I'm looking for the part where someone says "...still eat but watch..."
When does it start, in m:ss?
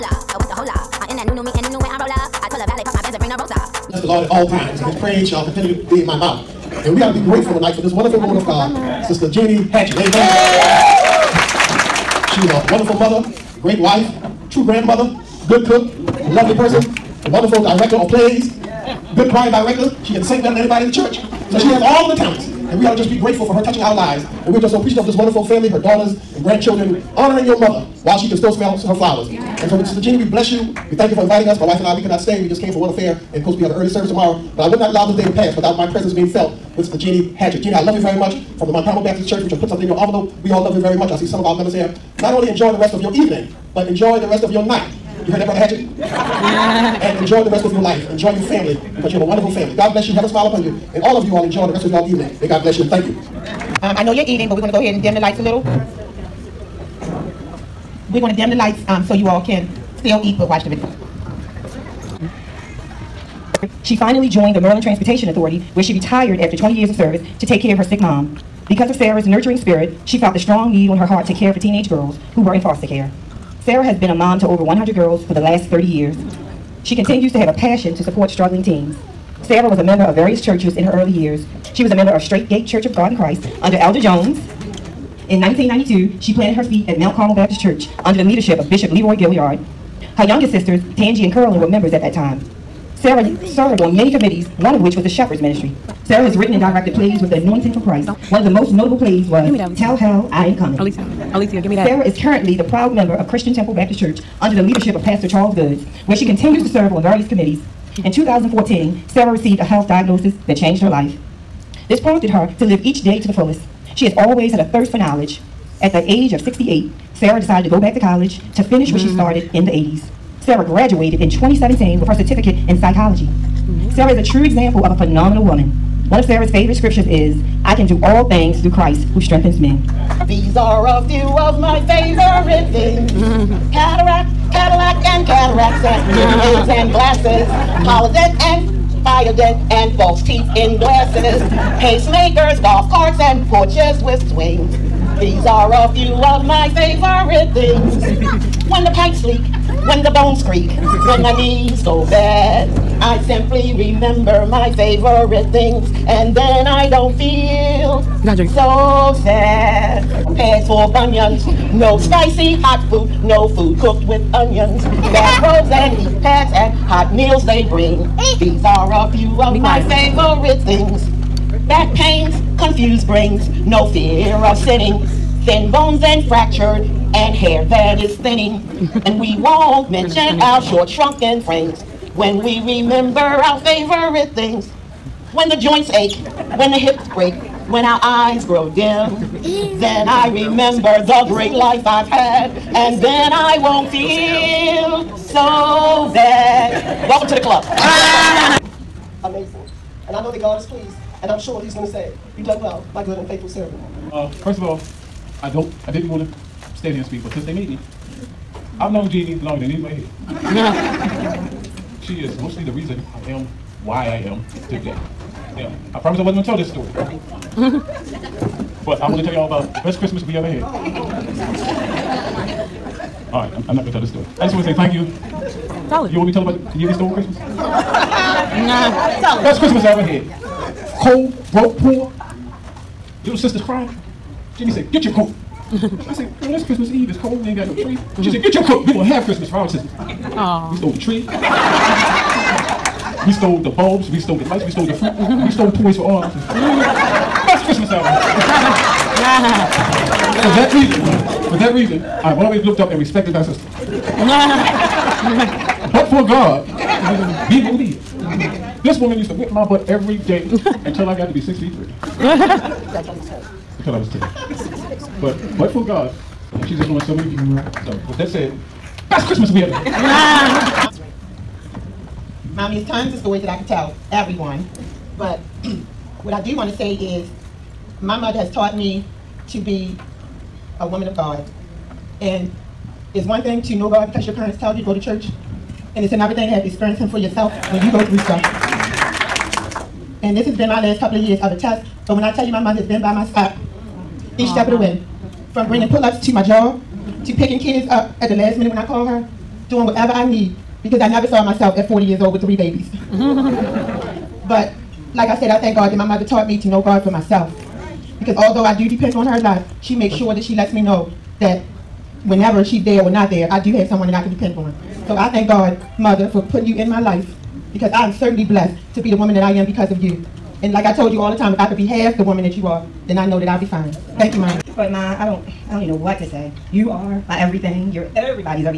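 0:59.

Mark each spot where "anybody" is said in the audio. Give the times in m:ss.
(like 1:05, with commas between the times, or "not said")
0:20, 3:29.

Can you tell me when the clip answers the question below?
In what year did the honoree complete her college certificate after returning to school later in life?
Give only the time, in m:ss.
2:01.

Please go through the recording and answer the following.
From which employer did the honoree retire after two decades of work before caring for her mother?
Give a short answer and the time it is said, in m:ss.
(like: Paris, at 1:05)
Maryland Transportation Authority, at 1:04.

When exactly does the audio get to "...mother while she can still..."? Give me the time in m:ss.
0:27.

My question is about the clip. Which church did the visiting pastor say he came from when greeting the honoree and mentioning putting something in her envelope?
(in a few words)
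Montgomery Baptist Church.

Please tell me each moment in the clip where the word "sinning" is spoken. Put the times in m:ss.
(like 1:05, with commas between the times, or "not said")
2:54.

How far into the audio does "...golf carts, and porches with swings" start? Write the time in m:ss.
2:22.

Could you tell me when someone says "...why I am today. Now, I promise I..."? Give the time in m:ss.
3:33.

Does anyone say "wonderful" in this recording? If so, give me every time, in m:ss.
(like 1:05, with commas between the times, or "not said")
0:07, 0:12, 0:17, 0:25, 0:49.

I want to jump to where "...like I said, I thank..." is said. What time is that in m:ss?
5:05.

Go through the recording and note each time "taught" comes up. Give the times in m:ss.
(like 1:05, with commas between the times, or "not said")
4:38, 5:06.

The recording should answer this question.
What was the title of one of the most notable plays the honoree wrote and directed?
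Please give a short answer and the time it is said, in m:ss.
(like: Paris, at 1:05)
Tell Hell I Ain't Coming, at 1:39.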